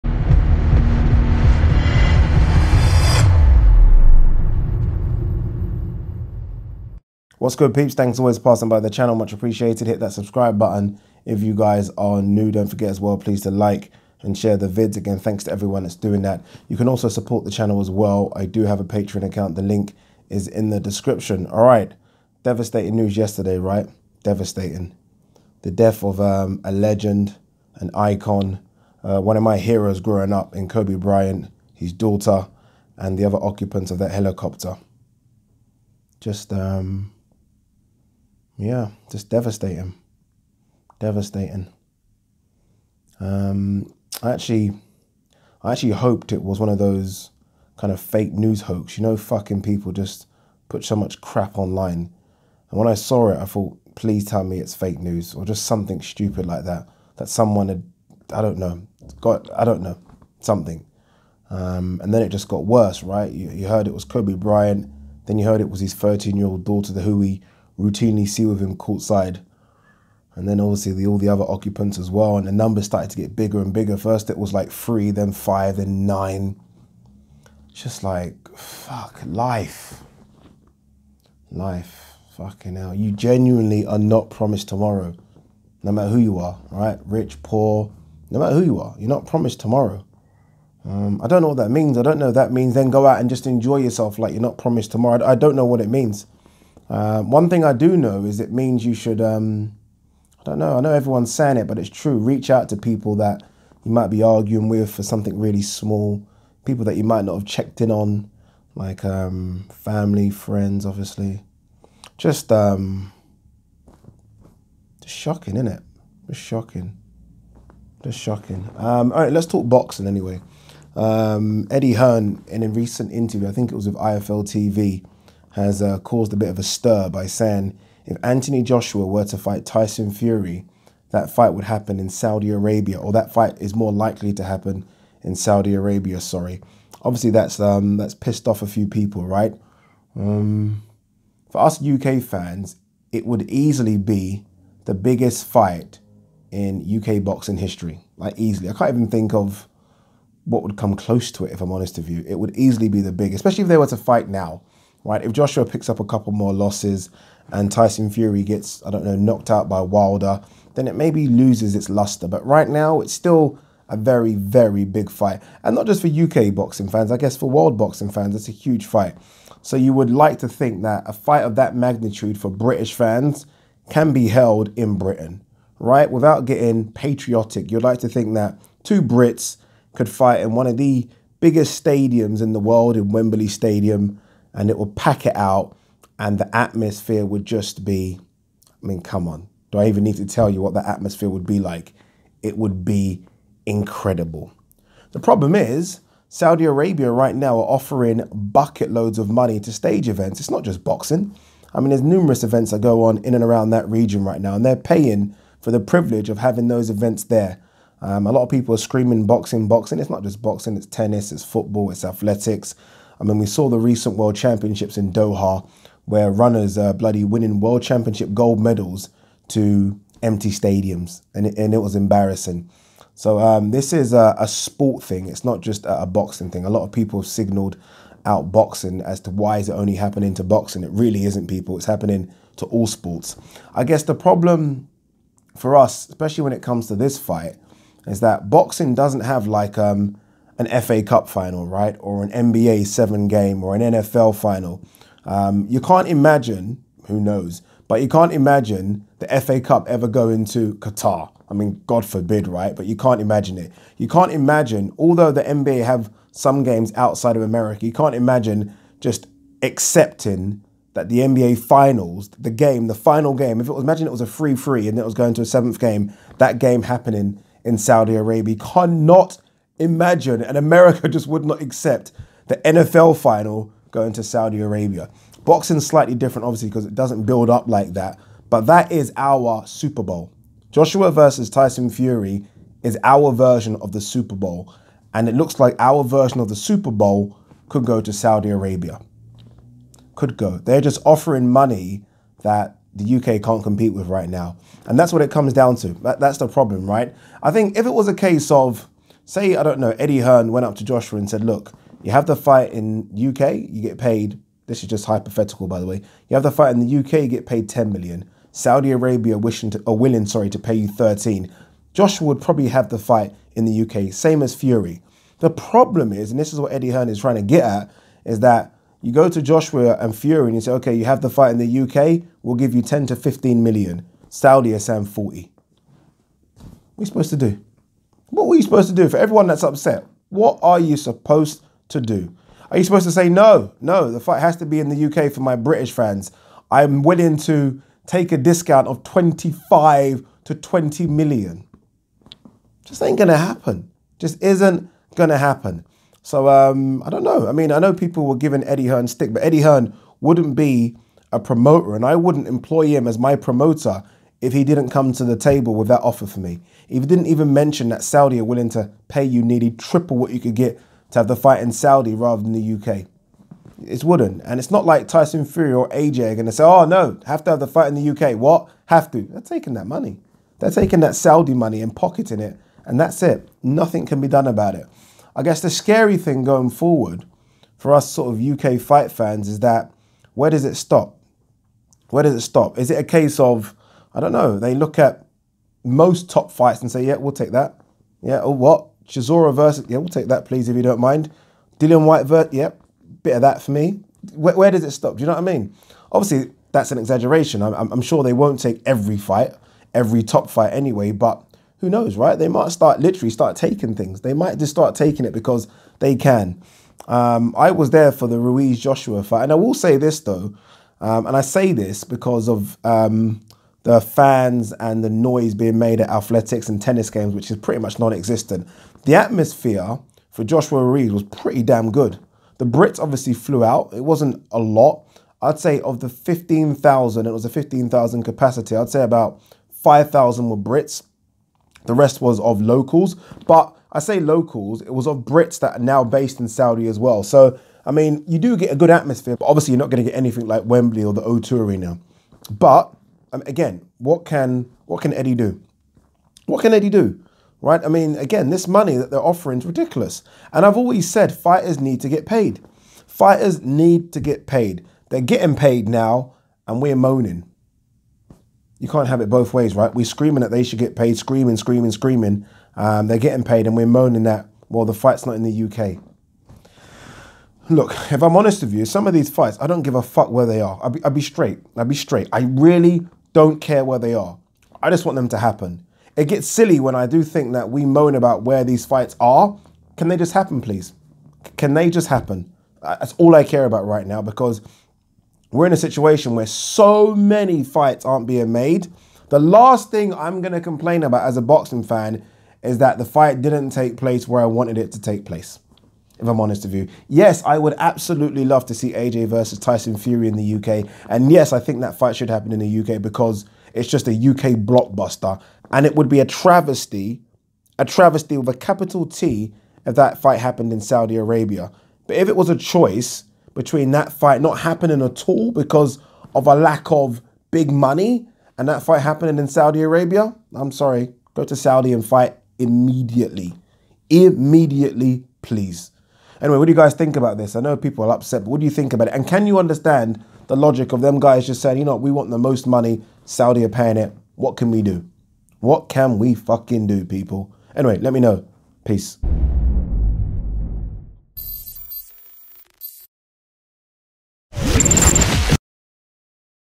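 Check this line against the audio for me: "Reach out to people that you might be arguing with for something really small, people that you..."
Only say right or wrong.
right.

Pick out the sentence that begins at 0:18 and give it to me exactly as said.
I do have a Patreon account.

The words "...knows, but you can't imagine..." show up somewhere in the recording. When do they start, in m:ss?
4:07.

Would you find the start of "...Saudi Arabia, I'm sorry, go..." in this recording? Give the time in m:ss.
8:39.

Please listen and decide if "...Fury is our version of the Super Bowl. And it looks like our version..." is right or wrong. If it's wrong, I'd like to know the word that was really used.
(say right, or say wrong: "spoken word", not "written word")
right.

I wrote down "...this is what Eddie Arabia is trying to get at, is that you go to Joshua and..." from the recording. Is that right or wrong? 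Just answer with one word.
wrong.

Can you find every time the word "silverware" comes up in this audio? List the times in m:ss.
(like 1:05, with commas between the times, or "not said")
not said.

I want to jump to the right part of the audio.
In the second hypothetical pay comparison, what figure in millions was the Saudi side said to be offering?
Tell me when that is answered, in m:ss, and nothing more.
5:25.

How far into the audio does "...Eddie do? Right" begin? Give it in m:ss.
7:26.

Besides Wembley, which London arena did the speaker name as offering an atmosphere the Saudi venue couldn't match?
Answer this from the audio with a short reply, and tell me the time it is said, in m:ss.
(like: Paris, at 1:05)
O2 Arena, at 7:21.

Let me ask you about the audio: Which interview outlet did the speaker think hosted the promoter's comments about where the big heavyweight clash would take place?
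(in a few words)
IFL TV.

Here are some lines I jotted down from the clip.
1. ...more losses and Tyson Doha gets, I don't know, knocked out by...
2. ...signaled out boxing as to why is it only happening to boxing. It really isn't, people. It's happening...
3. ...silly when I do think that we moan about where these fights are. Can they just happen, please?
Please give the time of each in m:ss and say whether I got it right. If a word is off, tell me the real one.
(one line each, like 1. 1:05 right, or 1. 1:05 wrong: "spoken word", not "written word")
1. 2:36 wrong: "Fury", not "Doha"
2. 3:47 right
3. 7:56 right.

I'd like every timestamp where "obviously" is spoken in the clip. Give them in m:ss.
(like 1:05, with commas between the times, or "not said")
1:10, 1:50, 2:17, 4:36, 6:36, 7:02, 7:19.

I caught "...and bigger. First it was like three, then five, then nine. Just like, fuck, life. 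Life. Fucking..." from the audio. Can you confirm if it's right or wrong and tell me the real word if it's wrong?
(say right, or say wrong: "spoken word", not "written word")
right.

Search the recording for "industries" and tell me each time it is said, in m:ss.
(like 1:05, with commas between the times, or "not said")
not said.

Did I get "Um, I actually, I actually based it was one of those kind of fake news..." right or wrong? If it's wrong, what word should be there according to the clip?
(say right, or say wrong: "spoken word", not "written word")
wrong: "hoped", not "based".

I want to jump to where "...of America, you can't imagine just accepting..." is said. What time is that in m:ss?
4:17.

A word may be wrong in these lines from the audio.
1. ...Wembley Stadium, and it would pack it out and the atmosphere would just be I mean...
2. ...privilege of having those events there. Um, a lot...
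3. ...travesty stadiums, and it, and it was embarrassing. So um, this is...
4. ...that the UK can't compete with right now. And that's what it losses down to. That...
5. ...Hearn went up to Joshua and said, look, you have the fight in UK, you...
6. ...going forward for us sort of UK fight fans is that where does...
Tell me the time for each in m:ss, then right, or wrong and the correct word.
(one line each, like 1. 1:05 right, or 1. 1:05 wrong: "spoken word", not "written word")
1. 3:03 right
2. 3:25 right
3. 3:40 wrong: "empty", not "travesty"
4. 4:52 wrong: "comes", not "losses"
5. 5:00 right
6. 6:16 right.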